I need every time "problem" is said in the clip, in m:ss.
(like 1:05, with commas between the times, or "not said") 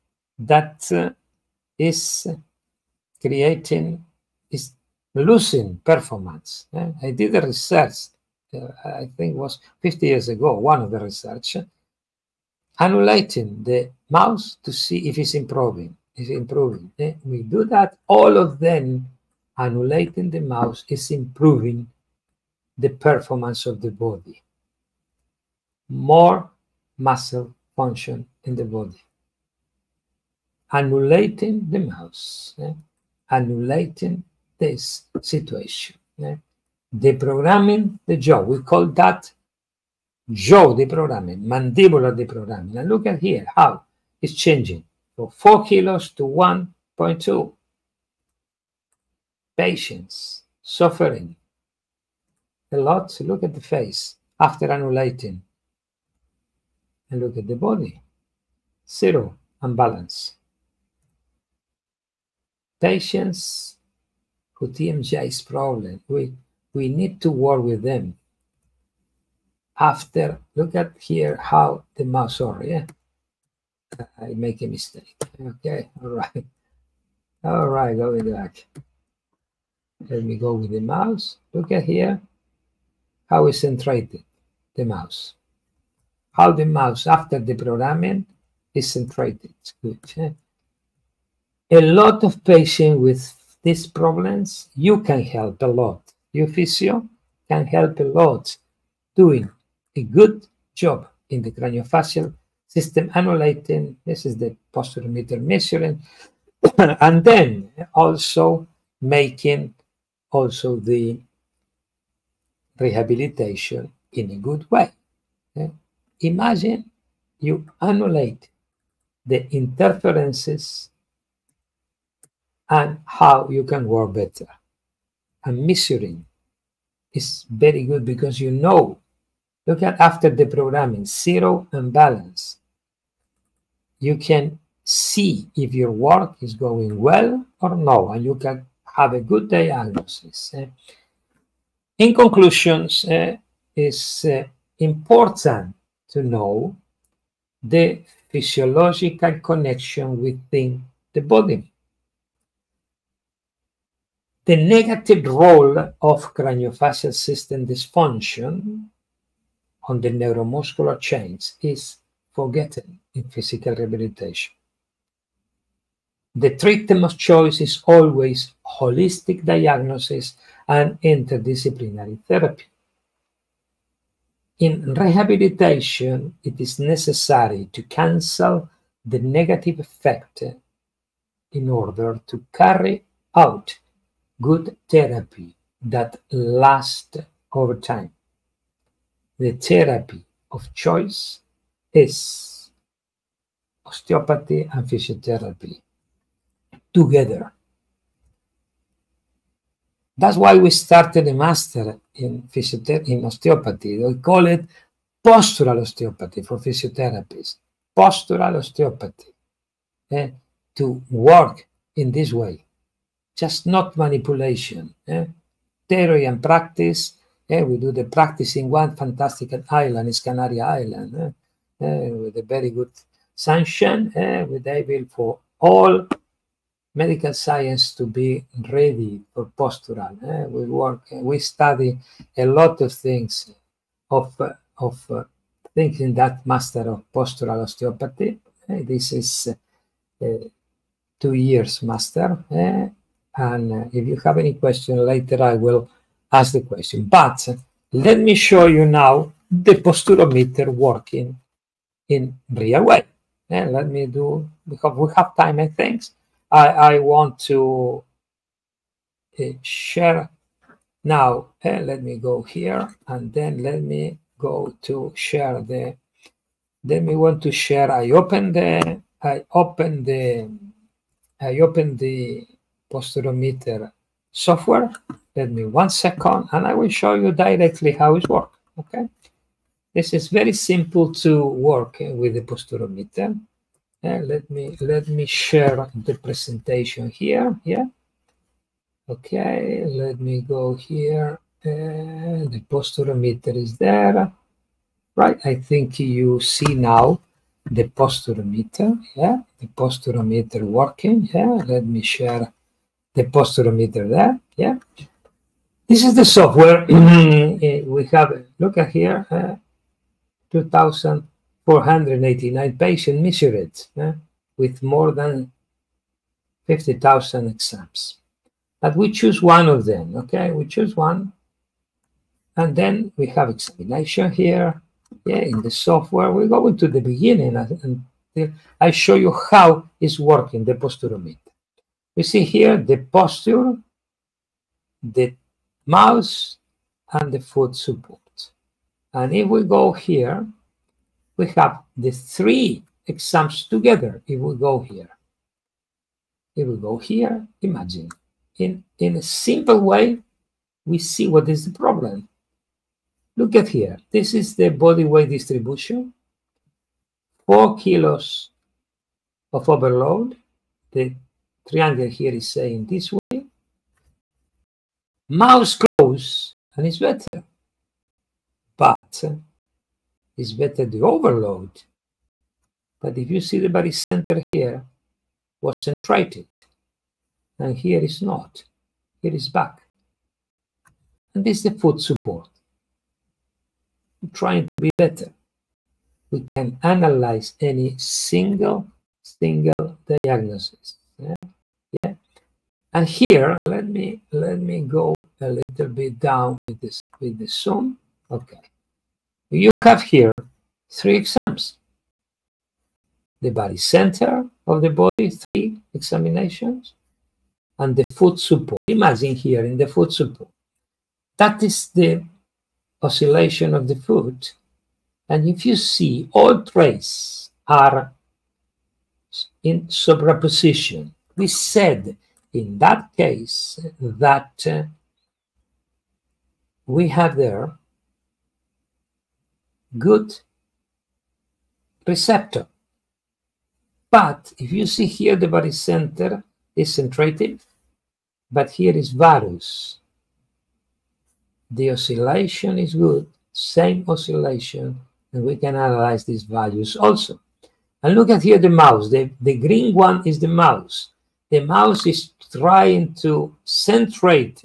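1:05, 1:33, 5:51.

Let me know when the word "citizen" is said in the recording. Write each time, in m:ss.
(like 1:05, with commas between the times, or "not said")
not said.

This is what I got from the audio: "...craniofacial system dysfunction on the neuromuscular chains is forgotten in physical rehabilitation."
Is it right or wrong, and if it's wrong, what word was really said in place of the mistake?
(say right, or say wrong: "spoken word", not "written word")
right.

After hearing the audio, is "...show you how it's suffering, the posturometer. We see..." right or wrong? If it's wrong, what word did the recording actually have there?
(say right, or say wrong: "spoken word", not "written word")
wrong: "working", not "suffering".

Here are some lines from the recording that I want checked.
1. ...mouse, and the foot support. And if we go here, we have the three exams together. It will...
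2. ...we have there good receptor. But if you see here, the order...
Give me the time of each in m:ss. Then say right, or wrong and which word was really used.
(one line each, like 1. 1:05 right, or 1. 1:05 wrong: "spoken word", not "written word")
1. 5:35 right
2. 7:06 wrong: "center", not "order".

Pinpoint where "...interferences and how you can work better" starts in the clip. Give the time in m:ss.
1:59.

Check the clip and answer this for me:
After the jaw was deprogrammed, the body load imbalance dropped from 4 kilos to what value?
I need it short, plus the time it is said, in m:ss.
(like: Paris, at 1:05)
1.2 kilos, at 0:46.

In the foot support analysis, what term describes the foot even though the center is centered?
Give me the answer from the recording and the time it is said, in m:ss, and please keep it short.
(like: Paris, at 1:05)
Varus, at 7:19.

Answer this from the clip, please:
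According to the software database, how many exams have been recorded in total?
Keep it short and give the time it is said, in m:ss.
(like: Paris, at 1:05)
More than 50,000, at 5:14.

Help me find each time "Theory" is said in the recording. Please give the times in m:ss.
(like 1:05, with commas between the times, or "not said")
3:35.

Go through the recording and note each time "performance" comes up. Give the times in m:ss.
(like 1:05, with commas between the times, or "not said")
0:05, 0:22.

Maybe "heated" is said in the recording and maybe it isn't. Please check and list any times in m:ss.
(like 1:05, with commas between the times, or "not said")
not said.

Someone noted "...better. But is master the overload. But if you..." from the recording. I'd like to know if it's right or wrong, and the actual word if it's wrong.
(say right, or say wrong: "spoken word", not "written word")
wrong: "better", not "master".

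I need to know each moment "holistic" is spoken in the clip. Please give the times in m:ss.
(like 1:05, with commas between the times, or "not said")
2:48.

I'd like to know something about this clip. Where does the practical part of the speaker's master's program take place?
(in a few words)
Canary Island.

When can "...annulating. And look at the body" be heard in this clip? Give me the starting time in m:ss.
0:54.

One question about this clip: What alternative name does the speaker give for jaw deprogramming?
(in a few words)
mandibular deprogramming.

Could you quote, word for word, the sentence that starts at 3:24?
We call it postural osteopathy for physiotherapists.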